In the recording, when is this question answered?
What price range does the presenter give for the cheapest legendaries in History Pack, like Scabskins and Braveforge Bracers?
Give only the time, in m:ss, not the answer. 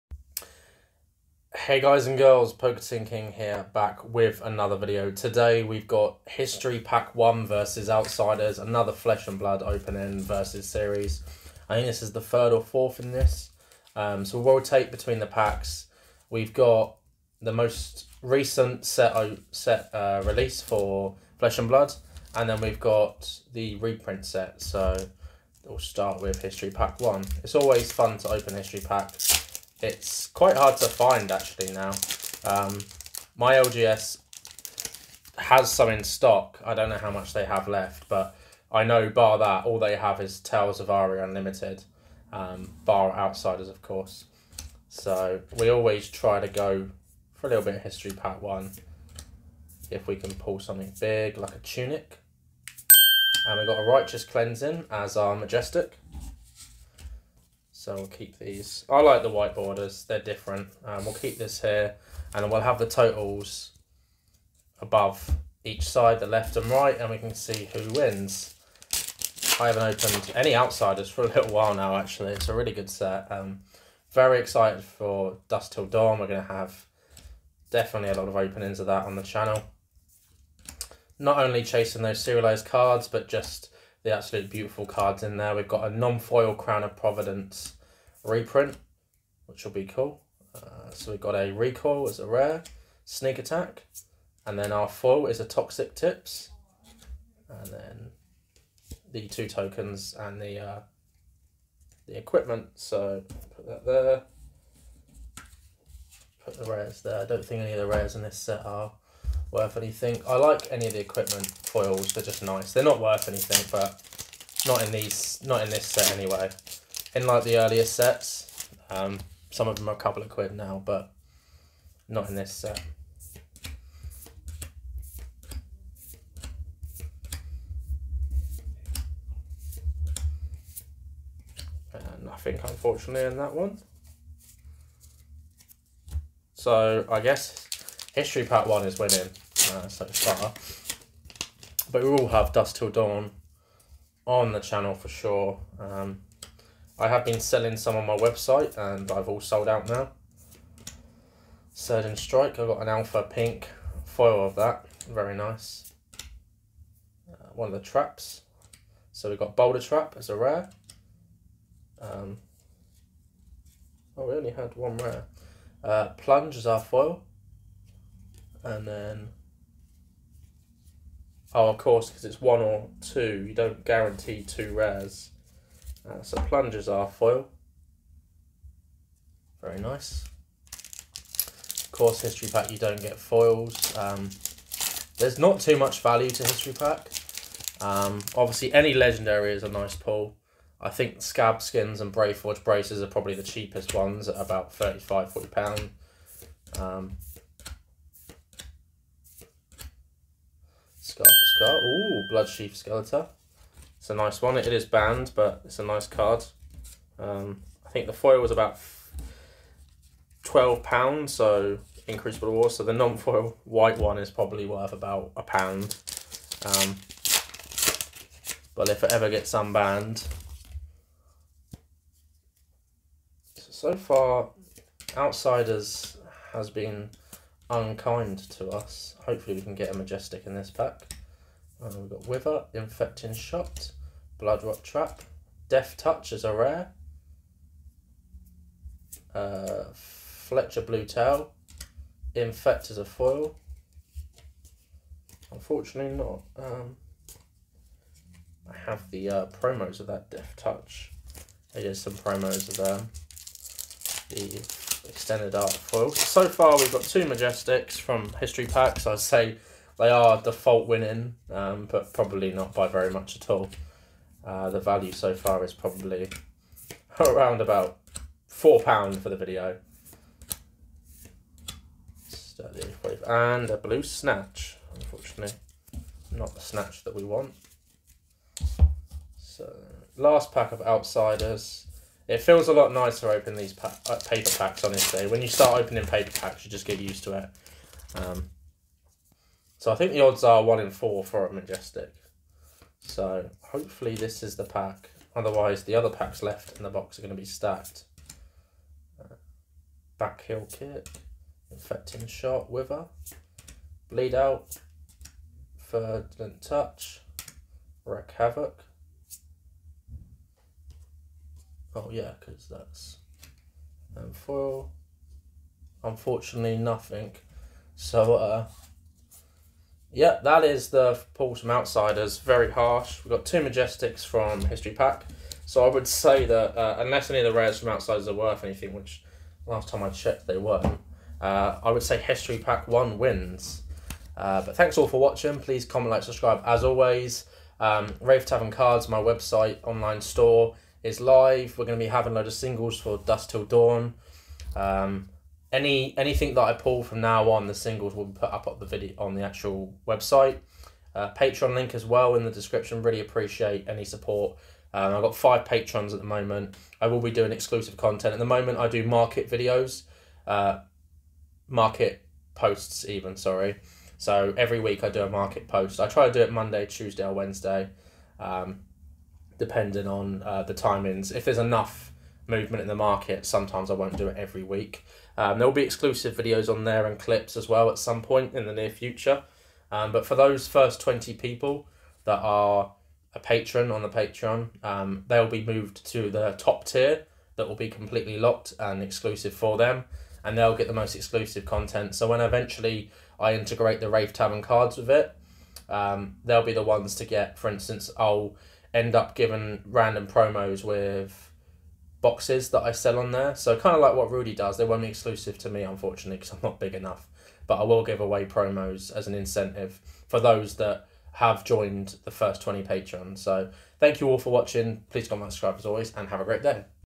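3:14.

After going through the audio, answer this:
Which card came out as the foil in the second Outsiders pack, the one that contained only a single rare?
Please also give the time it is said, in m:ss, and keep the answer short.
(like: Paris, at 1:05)
Plunge, at 2:46.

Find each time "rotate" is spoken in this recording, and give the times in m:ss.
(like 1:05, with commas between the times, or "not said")
0:14.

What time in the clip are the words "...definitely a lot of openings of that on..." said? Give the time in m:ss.
1:17.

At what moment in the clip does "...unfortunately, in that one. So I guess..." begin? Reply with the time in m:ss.
2:12.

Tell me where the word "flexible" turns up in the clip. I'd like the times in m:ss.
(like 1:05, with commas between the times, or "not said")
not said.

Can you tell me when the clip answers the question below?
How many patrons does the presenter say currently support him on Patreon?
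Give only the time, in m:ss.
5:55.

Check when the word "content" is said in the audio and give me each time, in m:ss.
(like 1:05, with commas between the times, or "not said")
5:57, 6:31.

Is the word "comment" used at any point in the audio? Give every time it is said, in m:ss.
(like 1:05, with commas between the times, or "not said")
5:35, 6:55.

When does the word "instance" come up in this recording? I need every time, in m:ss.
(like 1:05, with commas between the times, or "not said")
6:37.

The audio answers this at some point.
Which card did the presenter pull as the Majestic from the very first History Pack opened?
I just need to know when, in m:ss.
0:53.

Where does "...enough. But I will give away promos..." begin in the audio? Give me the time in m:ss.
6:46.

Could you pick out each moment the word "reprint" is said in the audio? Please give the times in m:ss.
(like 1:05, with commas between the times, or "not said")
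0:23, 1:28.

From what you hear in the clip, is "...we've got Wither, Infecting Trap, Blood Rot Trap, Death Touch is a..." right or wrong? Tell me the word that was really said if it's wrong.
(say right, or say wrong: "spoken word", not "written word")
wrong: "Shot", not "Trap".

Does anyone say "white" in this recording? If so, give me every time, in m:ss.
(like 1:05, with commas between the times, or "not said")
0:59, 3:33.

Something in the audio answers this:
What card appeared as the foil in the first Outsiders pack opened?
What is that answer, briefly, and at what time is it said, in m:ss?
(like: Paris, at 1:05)
Toxic Tips, at 1:35.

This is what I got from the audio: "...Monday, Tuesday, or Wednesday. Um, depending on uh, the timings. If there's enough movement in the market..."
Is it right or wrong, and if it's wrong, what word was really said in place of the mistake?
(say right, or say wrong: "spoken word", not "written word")
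right.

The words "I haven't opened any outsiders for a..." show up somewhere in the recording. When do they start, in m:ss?
1:09.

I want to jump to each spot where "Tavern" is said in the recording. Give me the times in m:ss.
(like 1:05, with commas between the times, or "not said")
5:38, 6:34.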